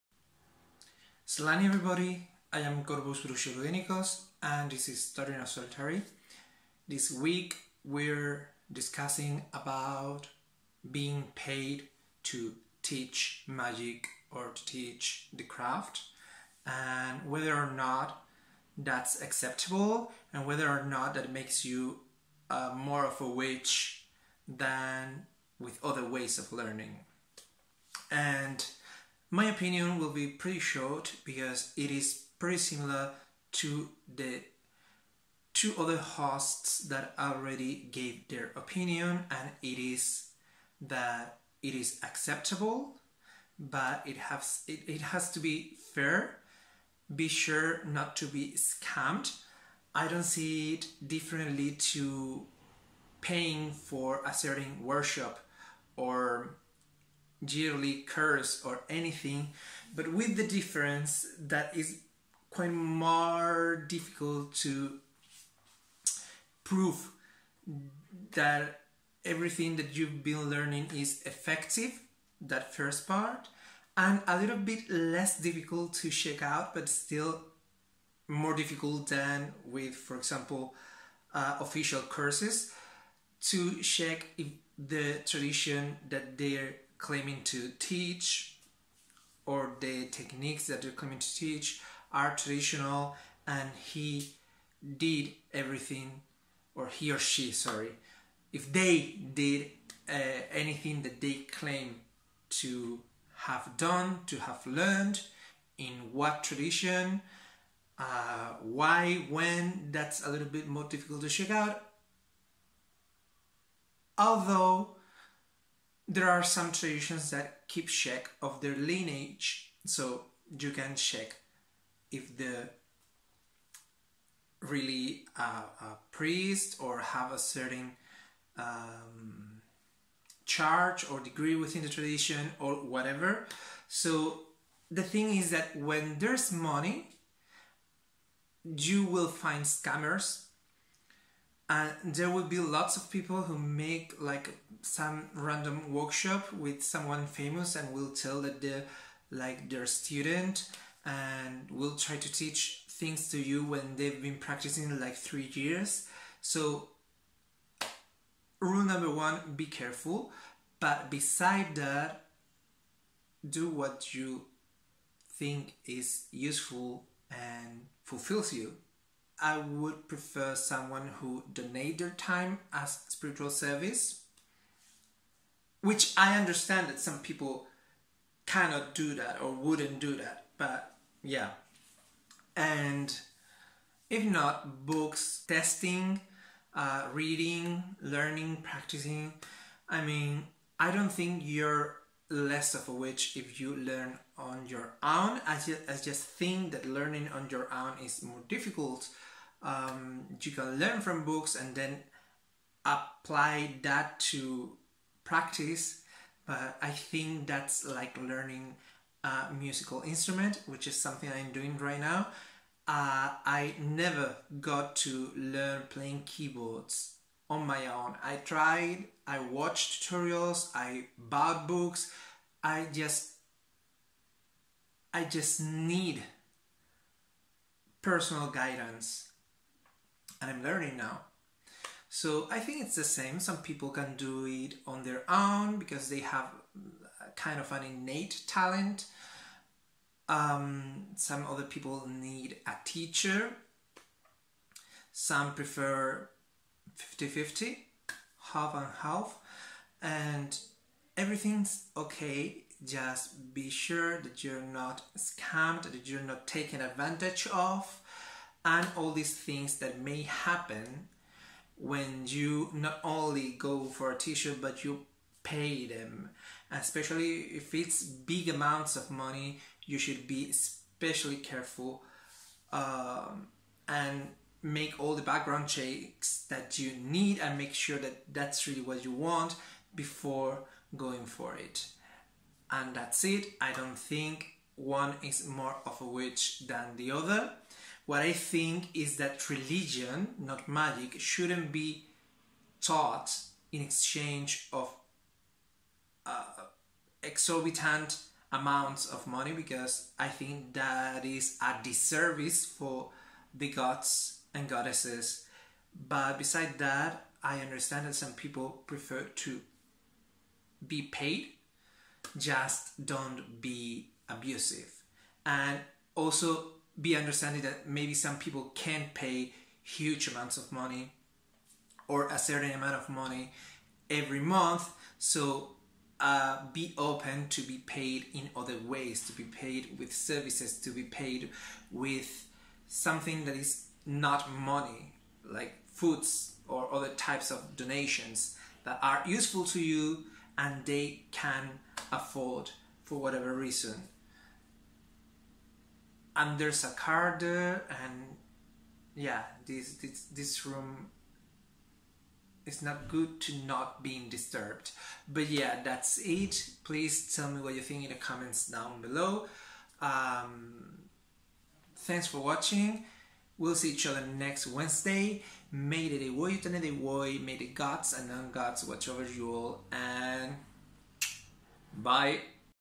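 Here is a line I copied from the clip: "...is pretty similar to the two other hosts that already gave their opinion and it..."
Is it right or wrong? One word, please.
right.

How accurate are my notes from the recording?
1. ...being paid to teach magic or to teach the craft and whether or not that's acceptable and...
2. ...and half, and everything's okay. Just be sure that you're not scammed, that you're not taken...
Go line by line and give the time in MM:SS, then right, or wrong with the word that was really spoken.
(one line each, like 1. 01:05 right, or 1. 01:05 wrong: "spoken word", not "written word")
1. 00:10 right
2. 04:08 right.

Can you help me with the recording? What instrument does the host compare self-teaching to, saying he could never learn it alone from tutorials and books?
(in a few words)
Keyboards.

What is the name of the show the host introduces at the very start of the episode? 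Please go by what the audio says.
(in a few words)
Starting Out Solitary.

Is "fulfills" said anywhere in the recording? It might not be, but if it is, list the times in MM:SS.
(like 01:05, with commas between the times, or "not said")
02:48.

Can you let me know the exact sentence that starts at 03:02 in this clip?
And if not, books, testing, uh, reading, learning, practicing.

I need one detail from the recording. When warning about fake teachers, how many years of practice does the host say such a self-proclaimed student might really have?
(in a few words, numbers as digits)
3.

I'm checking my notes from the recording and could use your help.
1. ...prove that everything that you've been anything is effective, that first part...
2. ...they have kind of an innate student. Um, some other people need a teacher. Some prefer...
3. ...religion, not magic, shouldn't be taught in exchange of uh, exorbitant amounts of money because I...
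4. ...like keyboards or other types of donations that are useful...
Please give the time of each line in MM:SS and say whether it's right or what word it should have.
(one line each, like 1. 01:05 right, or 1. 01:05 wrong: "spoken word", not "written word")
1. 01:06 wrong: "learning", not "anything"
2. 03:56 wrong: "talent", not "student"
3. 04:49 right
4. 05:35 wrong: "foods", not "keyboards".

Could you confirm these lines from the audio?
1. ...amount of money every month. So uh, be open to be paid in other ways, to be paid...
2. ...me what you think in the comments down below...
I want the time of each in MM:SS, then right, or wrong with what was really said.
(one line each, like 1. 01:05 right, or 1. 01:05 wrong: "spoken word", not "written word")
1. 05:22 right
2. 05:57 right.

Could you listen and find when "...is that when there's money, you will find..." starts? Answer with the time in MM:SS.
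02:15.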